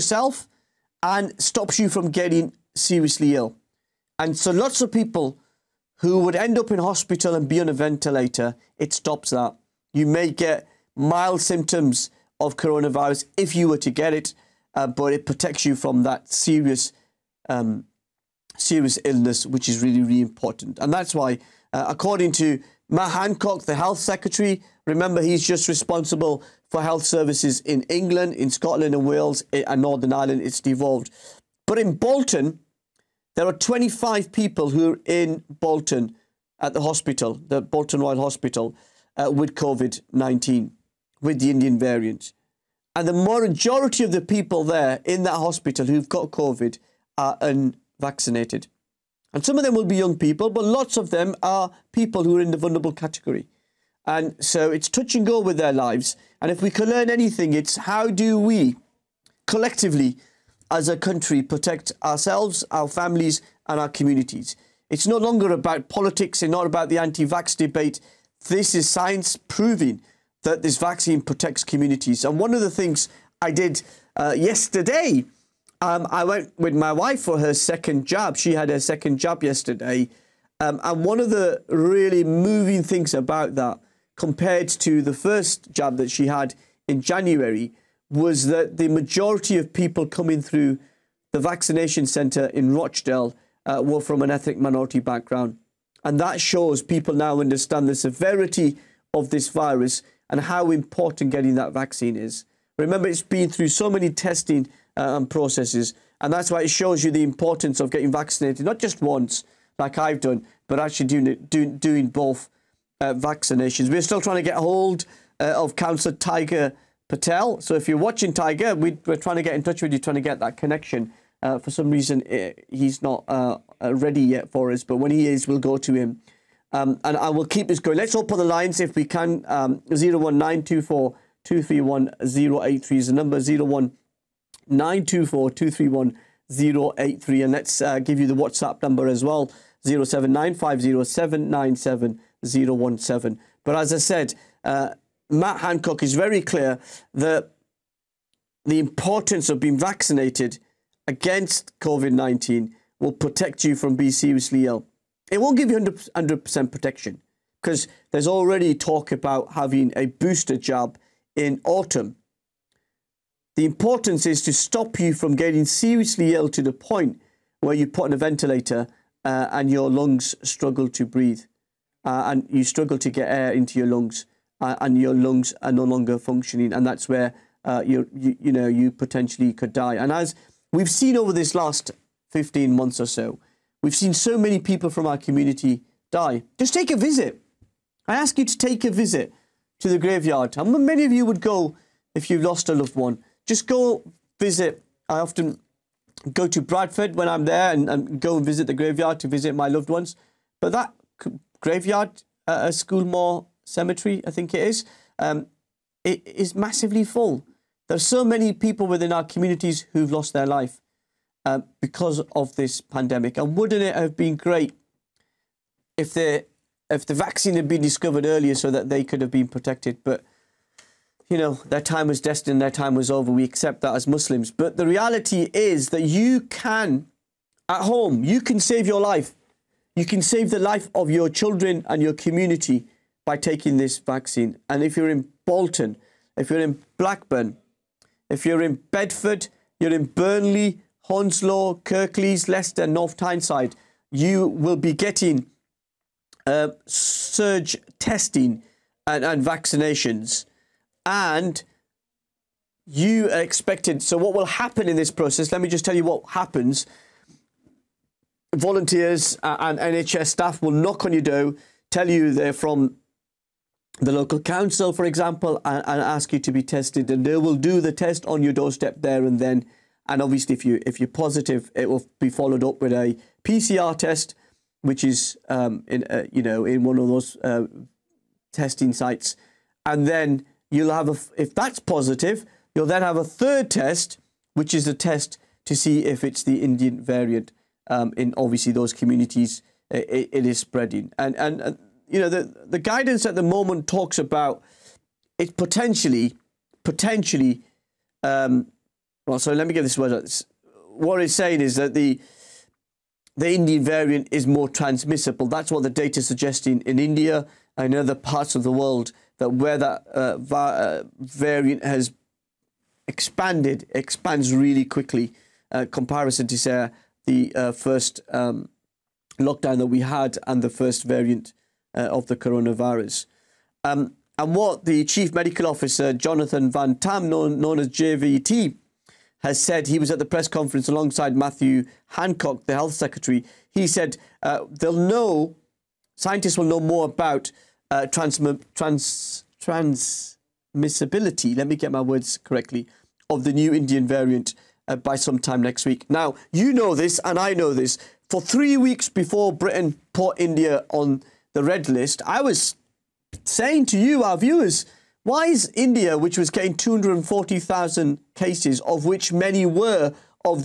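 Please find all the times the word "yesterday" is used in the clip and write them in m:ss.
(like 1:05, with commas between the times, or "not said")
1:14, 1:19.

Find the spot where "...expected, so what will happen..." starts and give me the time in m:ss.
4:13.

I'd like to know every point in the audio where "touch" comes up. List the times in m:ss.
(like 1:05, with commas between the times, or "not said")
0:54, 1:59.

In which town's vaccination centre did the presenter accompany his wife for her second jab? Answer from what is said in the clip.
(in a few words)
Rochdale.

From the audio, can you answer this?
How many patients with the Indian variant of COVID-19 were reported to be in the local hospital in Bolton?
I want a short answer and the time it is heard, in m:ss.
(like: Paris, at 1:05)
25, at 0:33.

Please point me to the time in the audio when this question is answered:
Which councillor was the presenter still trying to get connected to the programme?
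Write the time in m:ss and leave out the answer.
1:56.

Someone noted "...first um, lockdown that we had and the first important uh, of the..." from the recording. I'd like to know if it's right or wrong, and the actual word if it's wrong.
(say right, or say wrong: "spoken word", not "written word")
wrong: "variant", not "important".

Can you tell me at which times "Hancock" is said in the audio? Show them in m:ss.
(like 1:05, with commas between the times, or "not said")
0:23, 2:25, 5:32.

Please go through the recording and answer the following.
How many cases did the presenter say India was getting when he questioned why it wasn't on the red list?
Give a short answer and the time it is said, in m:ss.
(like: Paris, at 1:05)
240,000, at 5:56.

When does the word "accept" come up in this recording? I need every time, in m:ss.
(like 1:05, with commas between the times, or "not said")
3:43.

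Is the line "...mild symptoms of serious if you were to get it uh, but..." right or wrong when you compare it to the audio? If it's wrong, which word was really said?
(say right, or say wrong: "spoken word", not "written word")
wrong: "coronavirus", not "serious".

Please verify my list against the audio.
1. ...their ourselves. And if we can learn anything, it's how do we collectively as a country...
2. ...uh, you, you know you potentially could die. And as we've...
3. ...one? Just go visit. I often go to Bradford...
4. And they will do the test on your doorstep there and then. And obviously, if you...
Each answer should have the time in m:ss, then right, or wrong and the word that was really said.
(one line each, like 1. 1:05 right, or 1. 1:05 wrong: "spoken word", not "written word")
1. 0:55 wrong: "lives", not "ourselves"
2. 2:57 right
3. 3:12 right
4. 4:27 right.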